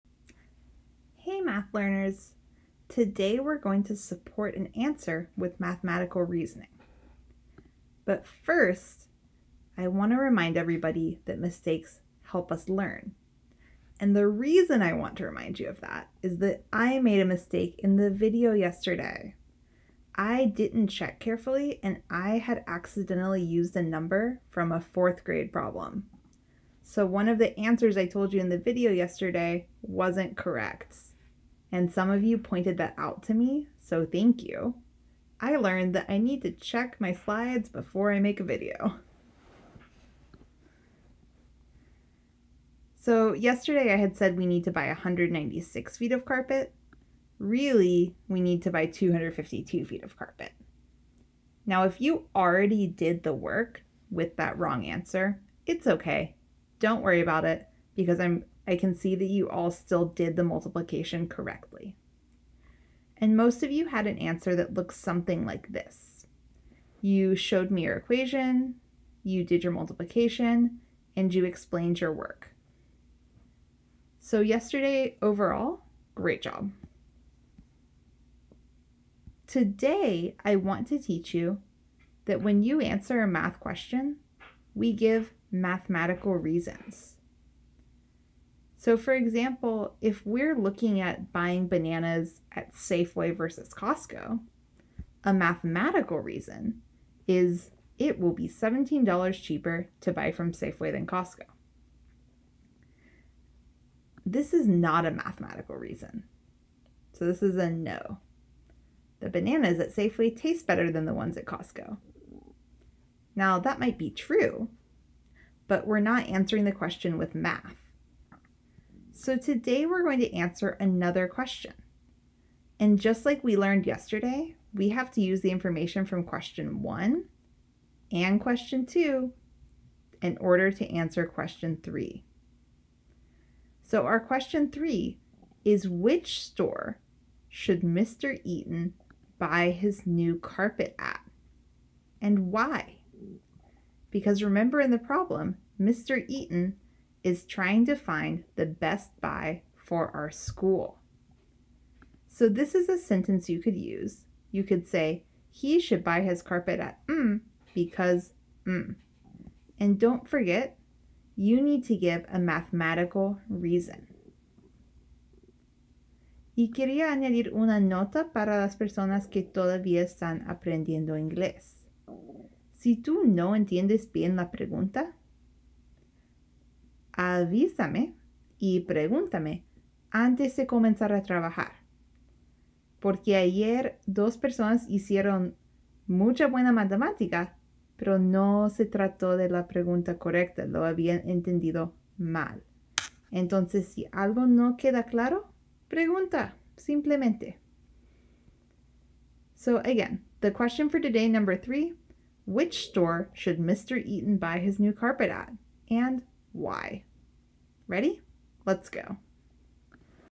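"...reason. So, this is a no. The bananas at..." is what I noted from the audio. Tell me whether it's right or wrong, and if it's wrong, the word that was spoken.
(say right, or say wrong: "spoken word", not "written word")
right.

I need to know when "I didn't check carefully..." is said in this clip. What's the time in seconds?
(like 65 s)
20 s.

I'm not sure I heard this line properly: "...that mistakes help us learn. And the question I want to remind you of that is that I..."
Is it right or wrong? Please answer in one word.
wrong.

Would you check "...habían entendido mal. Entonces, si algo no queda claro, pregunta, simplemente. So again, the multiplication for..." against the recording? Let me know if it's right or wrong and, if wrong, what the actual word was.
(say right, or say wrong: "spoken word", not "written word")
wrong: "question", not "multiplication".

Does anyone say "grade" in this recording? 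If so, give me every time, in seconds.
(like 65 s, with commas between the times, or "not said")
25 s.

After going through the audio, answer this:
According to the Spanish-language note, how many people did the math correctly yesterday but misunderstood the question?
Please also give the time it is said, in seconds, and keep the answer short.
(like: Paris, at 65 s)
2, at 184 s.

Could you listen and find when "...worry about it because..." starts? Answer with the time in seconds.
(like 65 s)
57 s.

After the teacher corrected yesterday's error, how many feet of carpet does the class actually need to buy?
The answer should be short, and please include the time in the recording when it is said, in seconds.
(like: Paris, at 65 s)
252, at 48 s.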